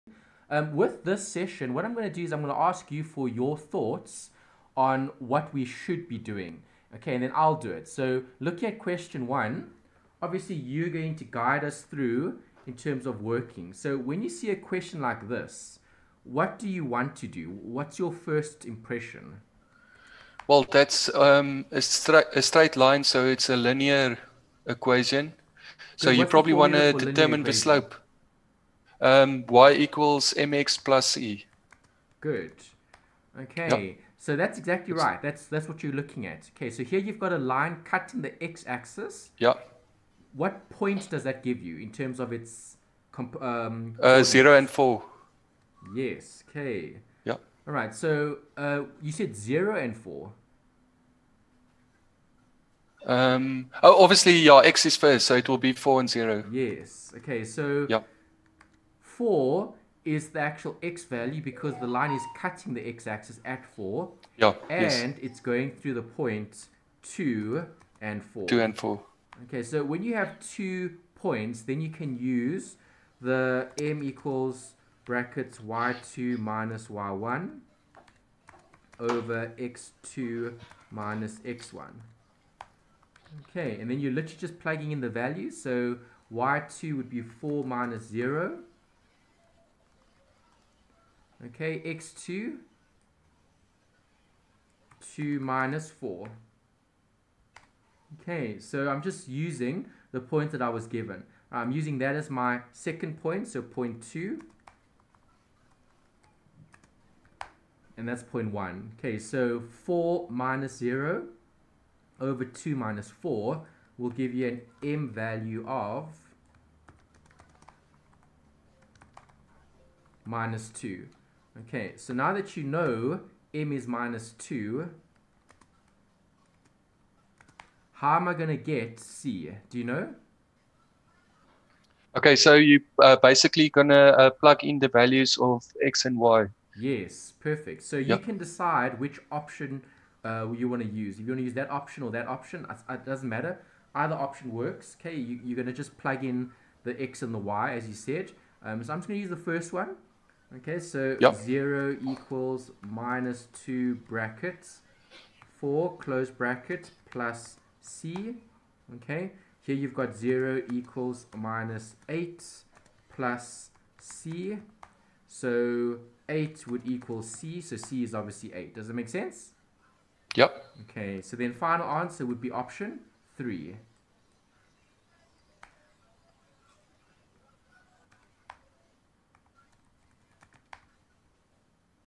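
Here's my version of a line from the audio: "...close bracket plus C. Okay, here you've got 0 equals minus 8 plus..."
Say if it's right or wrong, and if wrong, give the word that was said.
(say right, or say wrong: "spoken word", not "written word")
right.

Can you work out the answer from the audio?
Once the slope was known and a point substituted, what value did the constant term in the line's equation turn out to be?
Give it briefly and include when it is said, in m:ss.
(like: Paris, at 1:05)
8, at 2:47.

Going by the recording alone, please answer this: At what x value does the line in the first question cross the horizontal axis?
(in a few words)
4.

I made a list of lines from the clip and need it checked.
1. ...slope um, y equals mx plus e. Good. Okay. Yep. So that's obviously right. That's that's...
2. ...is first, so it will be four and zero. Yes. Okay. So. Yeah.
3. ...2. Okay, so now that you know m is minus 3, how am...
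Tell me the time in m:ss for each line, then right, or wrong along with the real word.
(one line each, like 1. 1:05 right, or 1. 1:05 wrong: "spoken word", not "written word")
1. 0:27 wrong: "exactly", not "obviously"
2. 0:54 right
3. 2:00 wrong: "2", not "3".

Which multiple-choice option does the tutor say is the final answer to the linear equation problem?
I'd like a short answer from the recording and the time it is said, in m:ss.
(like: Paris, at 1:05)
Option 3, at 2:52.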